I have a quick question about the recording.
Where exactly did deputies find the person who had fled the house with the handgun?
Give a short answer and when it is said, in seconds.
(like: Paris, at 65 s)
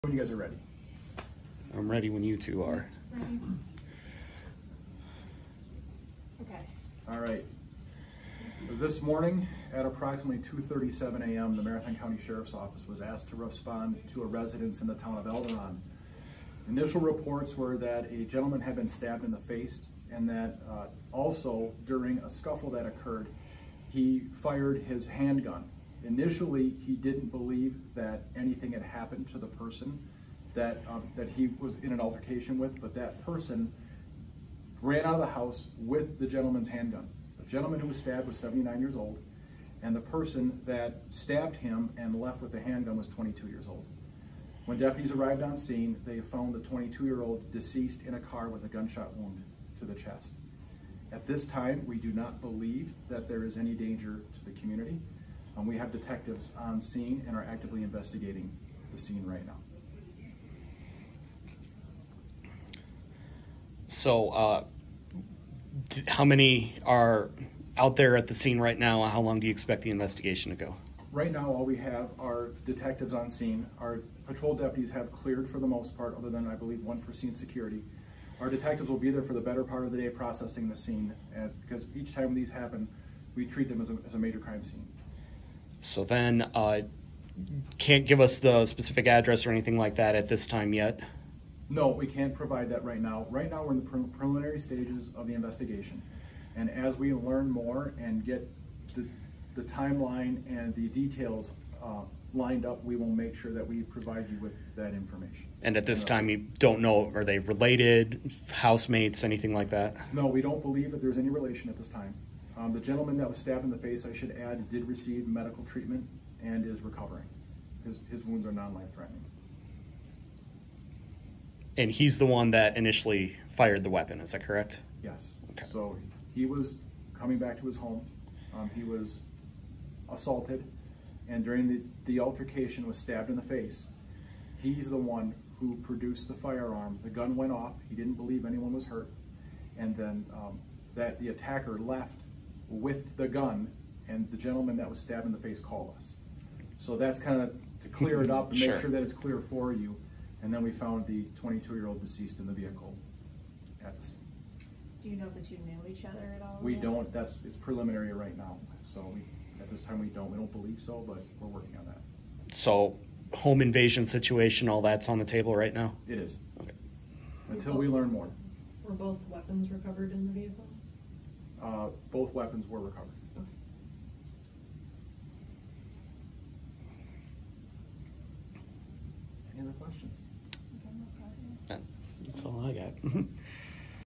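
In a car, at 48 s.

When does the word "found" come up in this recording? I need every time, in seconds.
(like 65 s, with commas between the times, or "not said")
46 s, 150 s.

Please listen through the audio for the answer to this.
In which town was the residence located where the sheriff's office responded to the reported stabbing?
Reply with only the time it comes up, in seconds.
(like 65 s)
15 s.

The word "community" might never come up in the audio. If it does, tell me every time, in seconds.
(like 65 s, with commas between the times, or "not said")
54 s.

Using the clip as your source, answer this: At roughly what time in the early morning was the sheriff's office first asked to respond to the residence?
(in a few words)
2:37 a.m.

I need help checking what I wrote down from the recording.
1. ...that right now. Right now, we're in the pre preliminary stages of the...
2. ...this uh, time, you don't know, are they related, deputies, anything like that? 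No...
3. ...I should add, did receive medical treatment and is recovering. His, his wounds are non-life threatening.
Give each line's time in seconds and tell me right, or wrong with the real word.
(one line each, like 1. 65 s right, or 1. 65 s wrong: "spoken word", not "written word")
1. 92 s right
2. 105 s wrong: "housemates", not "deputies"
3. 114 s right.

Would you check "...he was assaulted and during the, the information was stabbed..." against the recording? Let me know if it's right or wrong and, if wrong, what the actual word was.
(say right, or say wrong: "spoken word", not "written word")
wrong: "altercation", not "information".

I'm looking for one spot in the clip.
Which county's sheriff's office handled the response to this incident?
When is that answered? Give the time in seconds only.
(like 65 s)
11 s.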